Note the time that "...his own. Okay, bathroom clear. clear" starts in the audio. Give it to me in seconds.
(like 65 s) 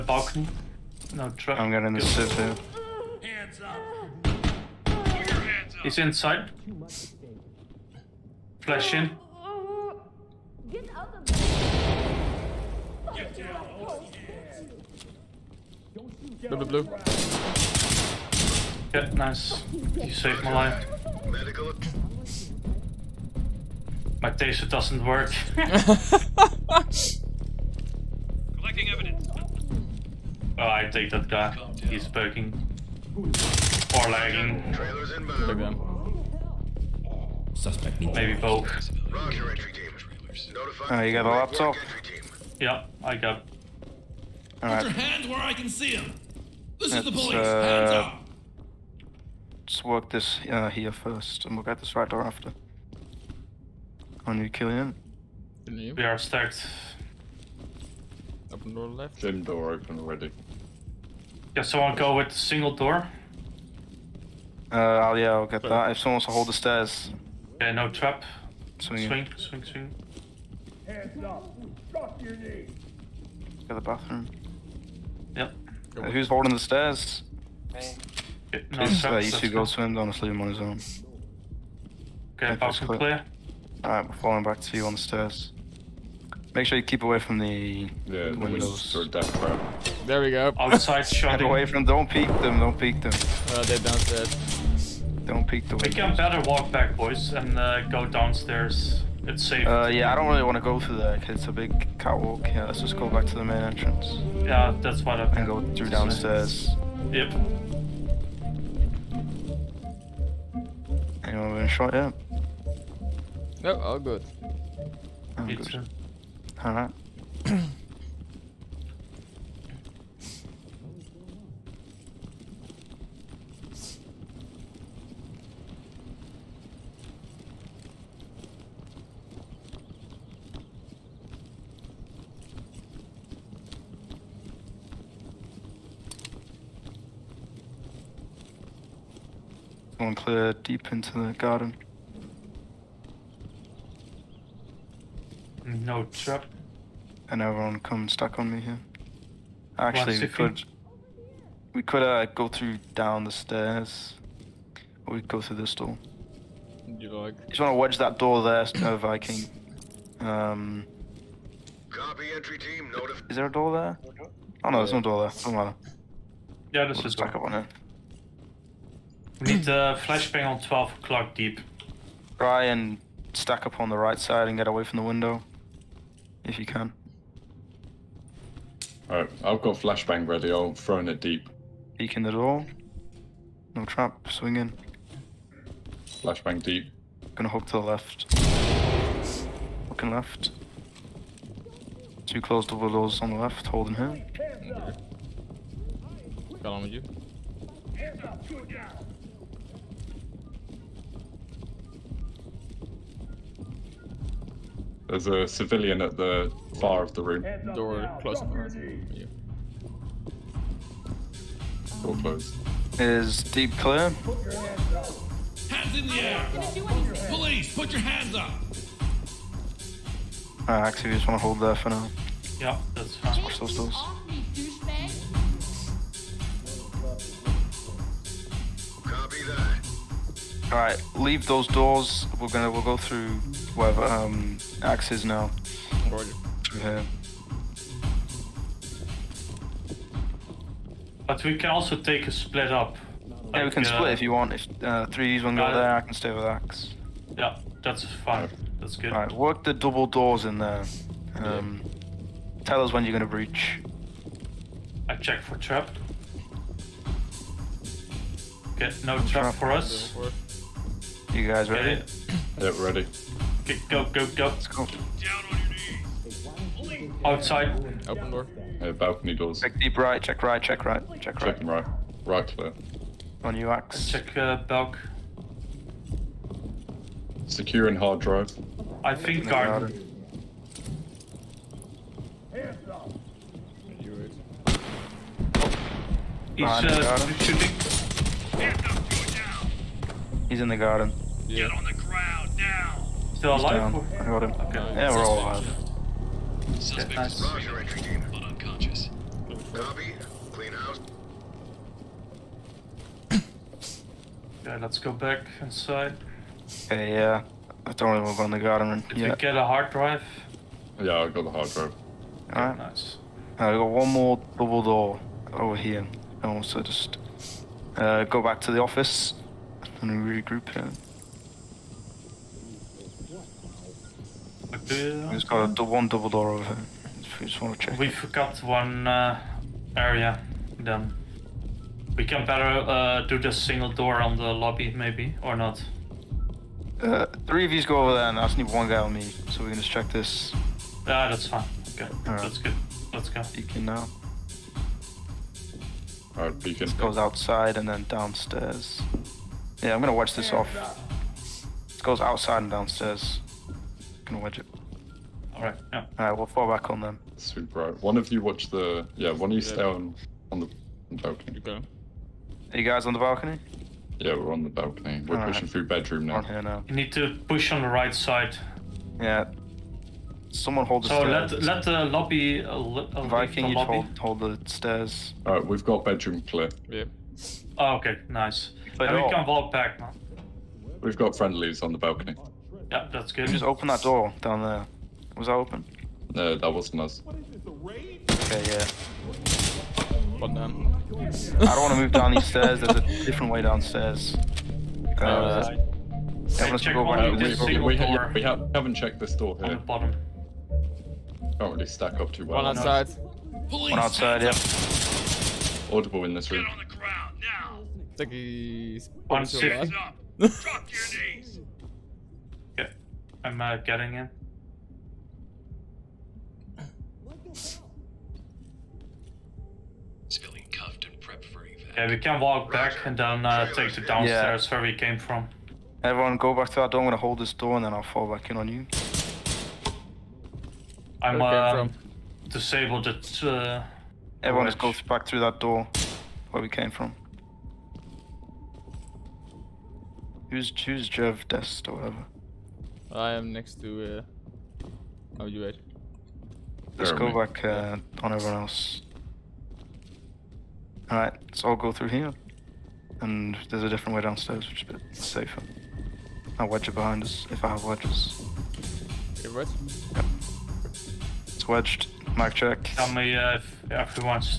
80 s.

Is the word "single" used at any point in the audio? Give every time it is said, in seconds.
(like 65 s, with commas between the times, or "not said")
62 s, 333 s.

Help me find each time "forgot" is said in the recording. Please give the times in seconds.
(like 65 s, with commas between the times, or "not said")
328 s.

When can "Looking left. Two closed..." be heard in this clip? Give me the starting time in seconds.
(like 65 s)
189 s.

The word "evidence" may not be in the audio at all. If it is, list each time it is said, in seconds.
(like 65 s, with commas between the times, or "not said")
28 s.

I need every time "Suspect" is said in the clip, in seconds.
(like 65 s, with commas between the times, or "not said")
37 s, 296 s.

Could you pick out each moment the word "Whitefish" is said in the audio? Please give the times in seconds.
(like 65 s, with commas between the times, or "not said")
not said.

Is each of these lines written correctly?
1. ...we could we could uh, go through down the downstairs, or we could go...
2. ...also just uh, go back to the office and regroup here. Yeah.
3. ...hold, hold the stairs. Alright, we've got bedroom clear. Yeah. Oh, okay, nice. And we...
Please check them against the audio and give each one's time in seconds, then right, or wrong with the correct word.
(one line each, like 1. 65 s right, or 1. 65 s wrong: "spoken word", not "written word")
1. 150 s wrong: "stairs", not "downstairs"
2. 316 s right
3. 373 s right.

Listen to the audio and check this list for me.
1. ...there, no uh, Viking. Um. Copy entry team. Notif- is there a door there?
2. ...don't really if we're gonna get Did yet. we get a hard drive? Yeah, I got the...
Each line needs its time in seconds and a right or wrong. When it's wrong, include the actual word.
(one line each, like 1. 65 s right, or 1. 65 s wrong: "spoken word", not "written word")
1. 158 s right
2. 307 s right.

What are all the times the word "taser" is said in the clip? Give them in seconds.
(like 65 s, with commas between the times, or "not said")
24 s.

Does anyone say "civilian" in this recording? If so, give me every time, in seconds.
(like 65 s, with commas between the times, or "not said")
205 s, 420 s.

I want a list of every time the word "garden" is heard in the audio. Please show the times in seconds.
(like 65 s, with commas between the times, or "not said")
141 s, 279 s, 290 s.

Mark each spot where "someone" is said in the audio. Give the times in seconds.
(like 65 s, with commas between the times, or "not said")
61 s, 65 s, 370 s.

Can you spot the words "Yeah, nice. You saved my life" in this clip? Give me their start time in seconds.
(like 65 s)
18 s.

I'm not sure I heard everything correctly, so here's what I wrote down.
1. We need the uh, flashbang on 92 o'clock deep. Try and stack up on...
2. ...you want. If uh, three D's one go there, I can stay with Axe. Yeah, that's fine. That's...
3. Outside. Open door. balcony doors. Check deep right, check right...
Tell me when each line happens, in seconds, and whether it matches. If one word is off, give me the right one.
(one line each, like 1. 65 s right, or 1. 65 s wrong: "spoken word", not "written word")
1. 169 s wrong: "12", not "92"
2. 244 s right
3. 267 s right.